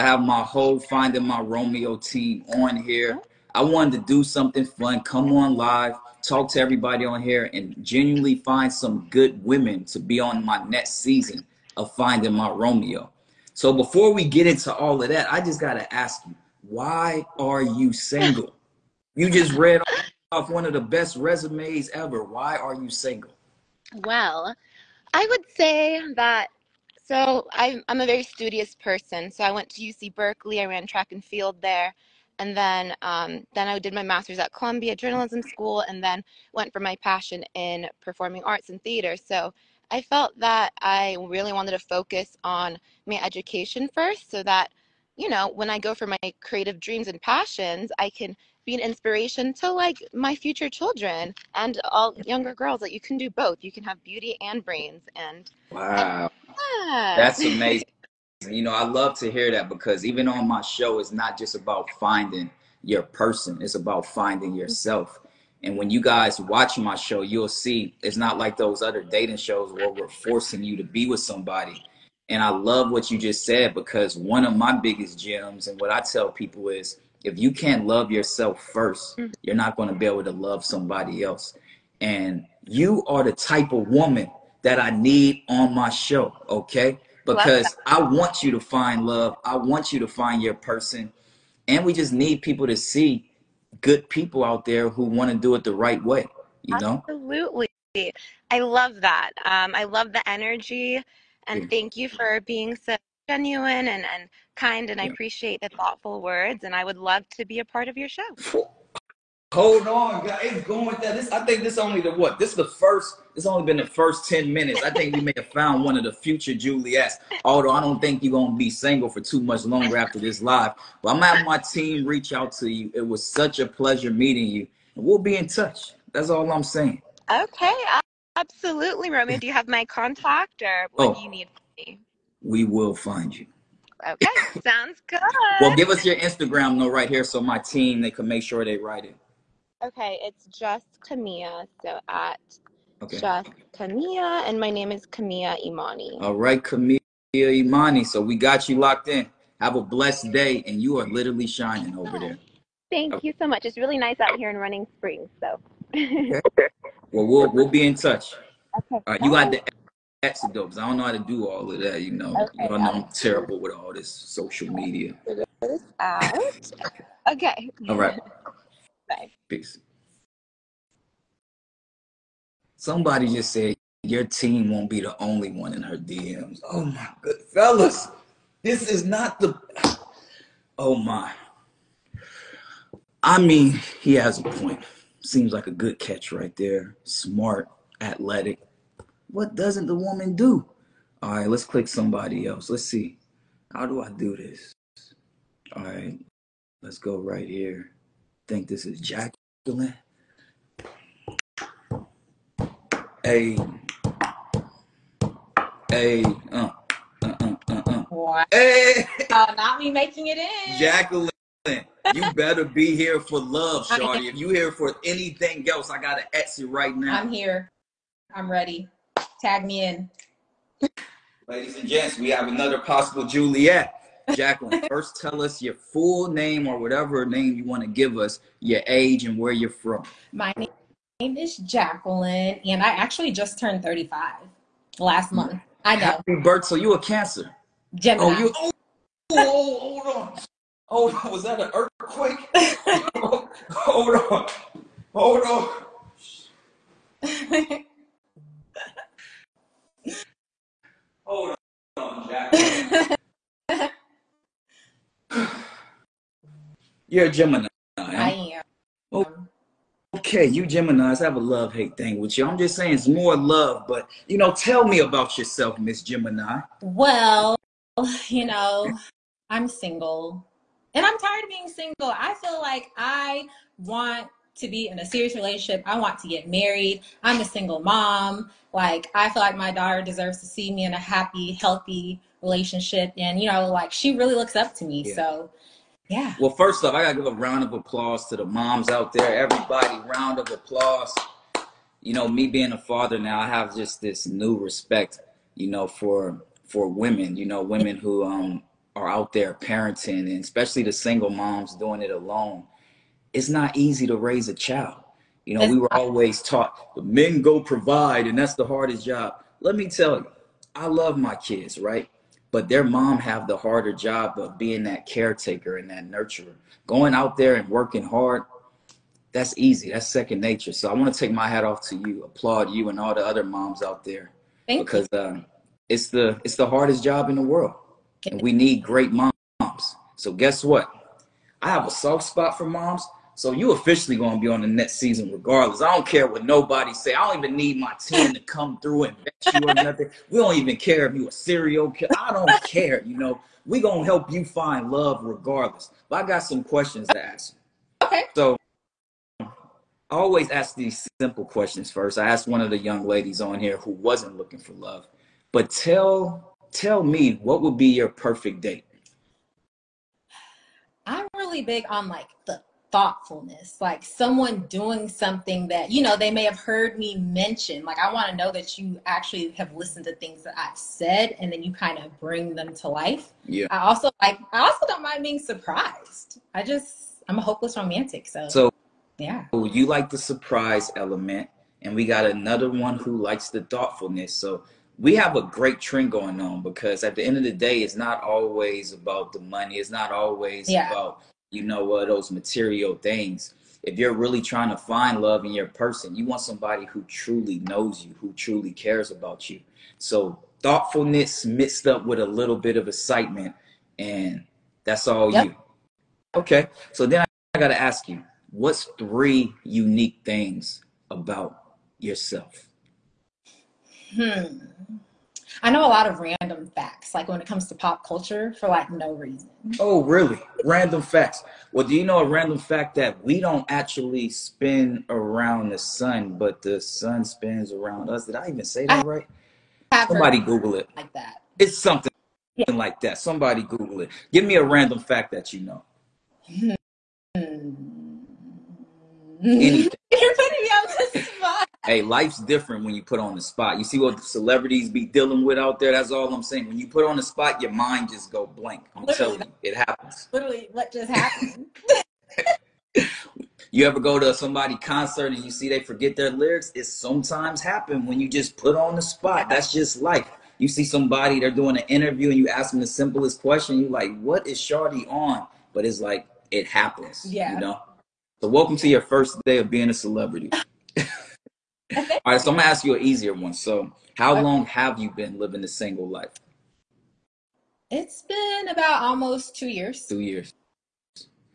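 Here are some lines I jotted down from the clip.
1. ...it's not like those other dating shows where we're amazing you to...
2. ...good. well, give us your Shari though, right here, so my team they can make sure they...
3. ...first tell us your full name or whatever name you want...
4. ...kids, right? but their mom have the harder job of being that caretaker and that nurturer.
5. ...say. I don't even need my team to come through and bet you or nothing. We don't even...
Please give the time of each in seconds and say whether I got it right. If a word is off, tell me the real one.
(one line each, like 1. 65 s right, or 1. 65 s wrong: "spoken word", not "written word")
1. 68 s wrong: "forcing", not "amazing"
2. 135 s wrong: "Instagram", not "Shari"
3. 224 s right
4. 311 s right
5. 336 s right.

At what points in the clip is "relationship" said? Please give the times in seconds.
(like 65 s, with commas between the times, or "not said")
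275 s, 282 s.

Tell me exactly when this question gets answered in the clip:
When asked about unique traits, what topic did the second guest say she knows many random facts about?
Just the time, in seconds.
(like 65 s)
417 s.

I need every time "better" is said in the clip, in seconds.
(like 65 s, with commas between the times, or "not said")
212 s.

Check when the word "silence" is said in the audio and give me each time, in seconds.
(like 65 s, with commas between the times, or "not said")
not said.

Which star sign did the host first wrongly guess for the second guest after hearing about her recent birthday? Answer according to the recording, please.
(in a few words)
Cancer.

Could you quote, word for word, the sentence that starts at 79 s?
you're not going to be able to love somebody else.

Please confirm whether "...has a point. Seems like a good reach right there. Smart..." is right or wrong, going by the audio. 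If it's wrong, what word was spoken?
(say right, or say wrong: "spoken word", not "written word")
wrong: "catch", not "reach".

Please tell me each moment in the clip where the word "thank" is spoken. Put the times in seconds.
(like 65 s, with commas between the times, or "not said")
101 s, 152 s, 324 s.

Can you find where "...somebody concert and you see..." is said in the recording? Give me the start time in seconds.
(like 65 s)
454 s.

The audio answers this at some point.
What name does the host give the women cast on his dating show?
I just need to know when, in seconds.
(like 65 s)
116 s.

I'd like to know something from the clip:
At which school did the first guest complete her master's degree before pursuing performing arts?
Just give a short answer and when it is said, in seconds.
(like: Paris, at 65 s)
Columbia Journalism School, at 34 s.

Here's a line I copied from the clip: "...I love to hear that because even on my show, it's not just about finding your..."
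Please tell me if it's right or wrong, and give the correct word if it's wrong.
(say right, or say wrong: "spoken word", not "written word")
right.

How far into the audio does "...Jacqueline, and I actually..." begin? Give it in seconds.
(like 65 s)
231 s.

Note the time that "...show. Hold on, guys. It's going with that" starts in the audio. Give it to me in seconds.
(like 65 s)
108 s.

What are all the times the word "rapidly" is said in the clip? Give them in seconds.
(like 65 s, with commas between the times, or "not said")
not said.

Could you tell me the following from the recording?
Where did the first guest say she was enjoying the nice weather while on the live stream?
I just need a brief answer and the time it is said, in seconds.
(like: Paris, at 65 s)
Running Springs, at 154 s.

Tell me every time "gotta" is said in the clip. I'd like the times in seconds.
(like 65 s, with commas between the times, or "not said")
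215 s, 287 s.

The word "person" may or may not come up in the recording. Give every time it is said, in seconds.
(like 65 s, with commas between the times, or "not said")
28 s, 63 s, 90 s, 395 s.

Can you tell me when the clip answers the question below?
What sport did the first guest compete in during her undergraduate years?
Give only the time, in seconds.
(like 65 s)
30 s.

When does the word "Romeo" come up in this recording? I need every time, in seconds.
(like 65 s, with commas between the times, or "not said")
1 s, 12 s.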